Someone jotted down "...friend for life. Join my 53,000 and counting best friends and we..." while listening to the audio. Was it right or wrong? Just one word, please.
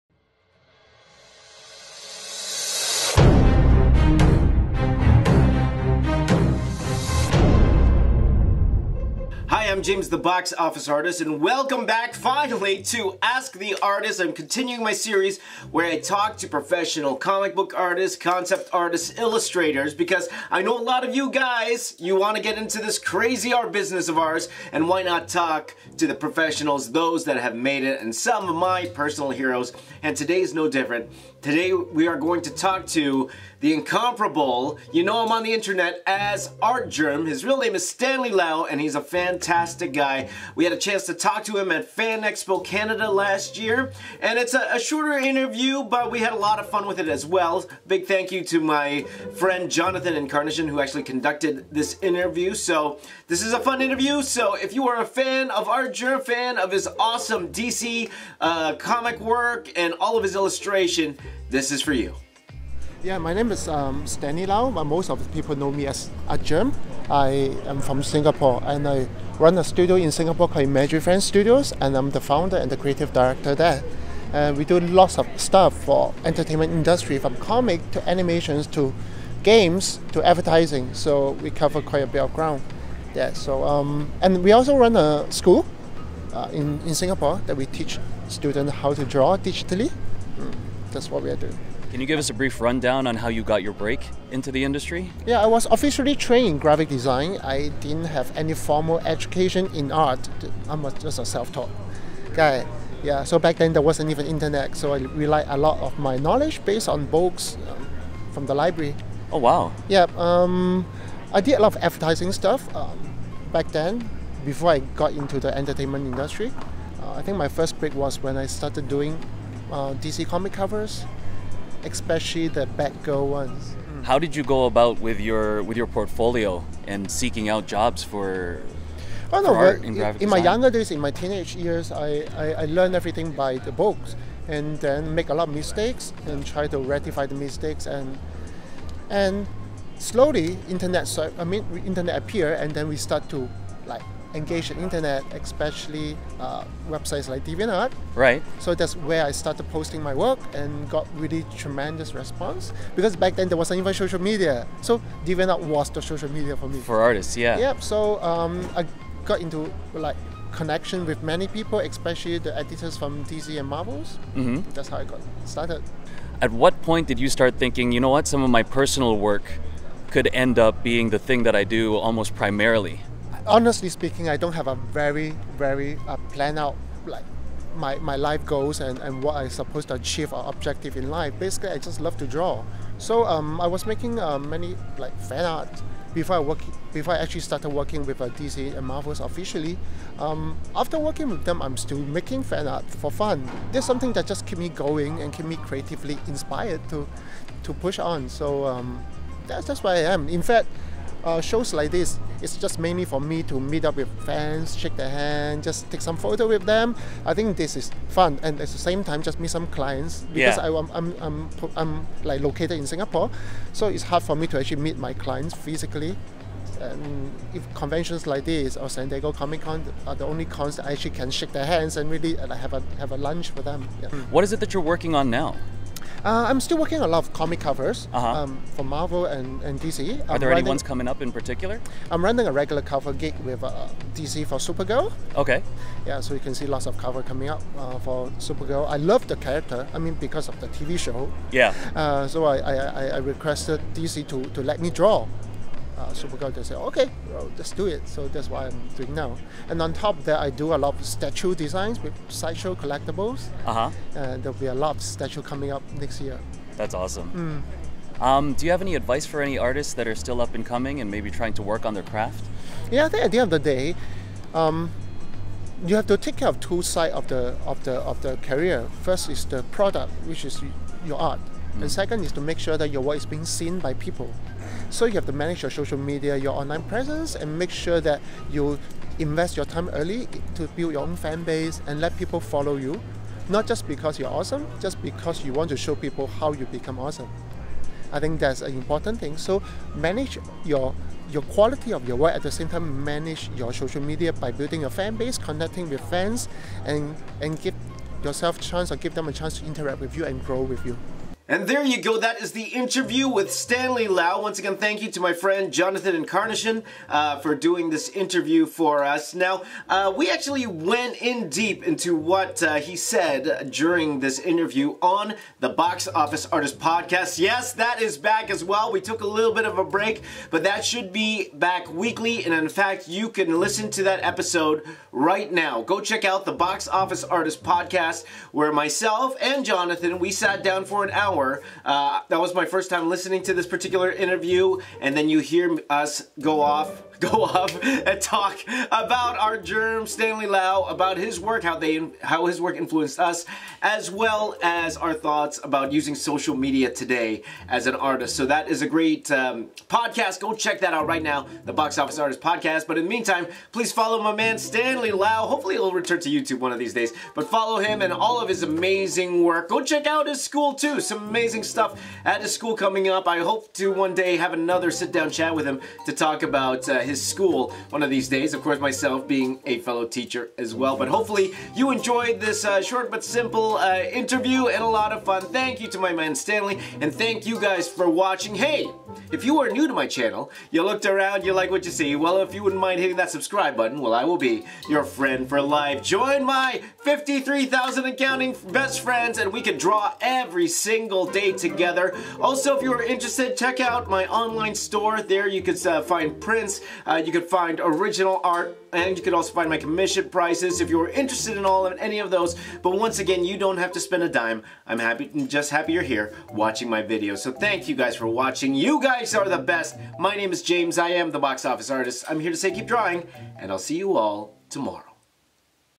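right.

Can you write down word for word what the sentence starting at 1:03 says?
Yeah, my name is um, Stanley Lau, but most of the people know me as Artgerm.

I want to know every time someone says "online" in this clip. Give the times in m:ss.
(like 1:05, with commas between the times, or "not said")
4:36, 6:34.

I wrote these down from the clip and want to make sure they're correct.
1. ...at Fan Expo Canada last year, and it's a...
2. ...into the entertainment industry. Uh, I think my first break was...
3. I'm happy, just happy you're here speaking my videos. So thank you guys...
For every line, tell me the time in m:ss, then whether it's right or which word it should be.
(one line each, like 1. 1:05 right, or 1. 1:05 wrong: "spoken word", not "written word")
1. 0:41 right
2. 1:55 right
3. 6:44 wrong: "watching", not "speaking".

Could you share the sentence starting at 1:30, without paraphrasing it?
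Mm, that's what we are doing.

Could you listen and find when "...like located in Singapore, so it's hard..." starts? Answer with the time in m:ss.
3:32.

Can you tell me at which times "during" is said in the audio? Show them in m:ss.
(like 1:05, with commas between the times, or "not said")
5:13.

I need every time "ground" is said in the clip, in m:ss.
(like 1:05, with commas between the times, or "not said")
1:22.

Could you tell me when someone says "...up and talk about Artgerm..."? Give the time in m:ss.
5:37.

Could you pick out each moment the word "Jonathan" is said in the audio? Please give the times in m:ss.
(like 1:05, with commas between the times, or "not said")
0:49, 5:05, 5:29.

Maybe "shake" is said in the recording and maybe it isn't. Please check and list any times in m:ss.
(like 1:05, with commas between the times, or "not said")
3:24, 3:41.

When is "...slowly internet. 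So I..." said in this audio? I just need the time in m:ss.
2:19.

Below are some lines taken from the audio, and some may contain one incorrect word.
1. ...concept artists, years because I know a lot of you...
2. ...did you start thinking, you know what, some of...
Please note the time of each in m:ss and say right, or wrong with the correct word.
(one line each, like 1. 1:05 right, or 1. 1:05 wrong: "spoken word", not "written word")
1. 0:18 wrong: "illustrators", not "years"
2. 2:47 right.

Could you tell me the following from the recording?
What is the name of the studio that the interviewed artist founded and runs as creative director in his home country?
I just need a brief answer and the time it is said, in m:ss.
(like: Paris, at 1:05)
Imaginary Friends Studios, at 1:10.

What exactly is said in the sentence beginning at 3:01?
Basically, I just love to draw.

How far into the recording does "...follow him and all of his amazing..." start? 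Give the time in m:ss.
5:57.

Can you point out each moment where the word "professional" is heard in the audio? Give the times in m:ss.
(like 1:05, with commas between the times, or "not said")
0:16, 0:26.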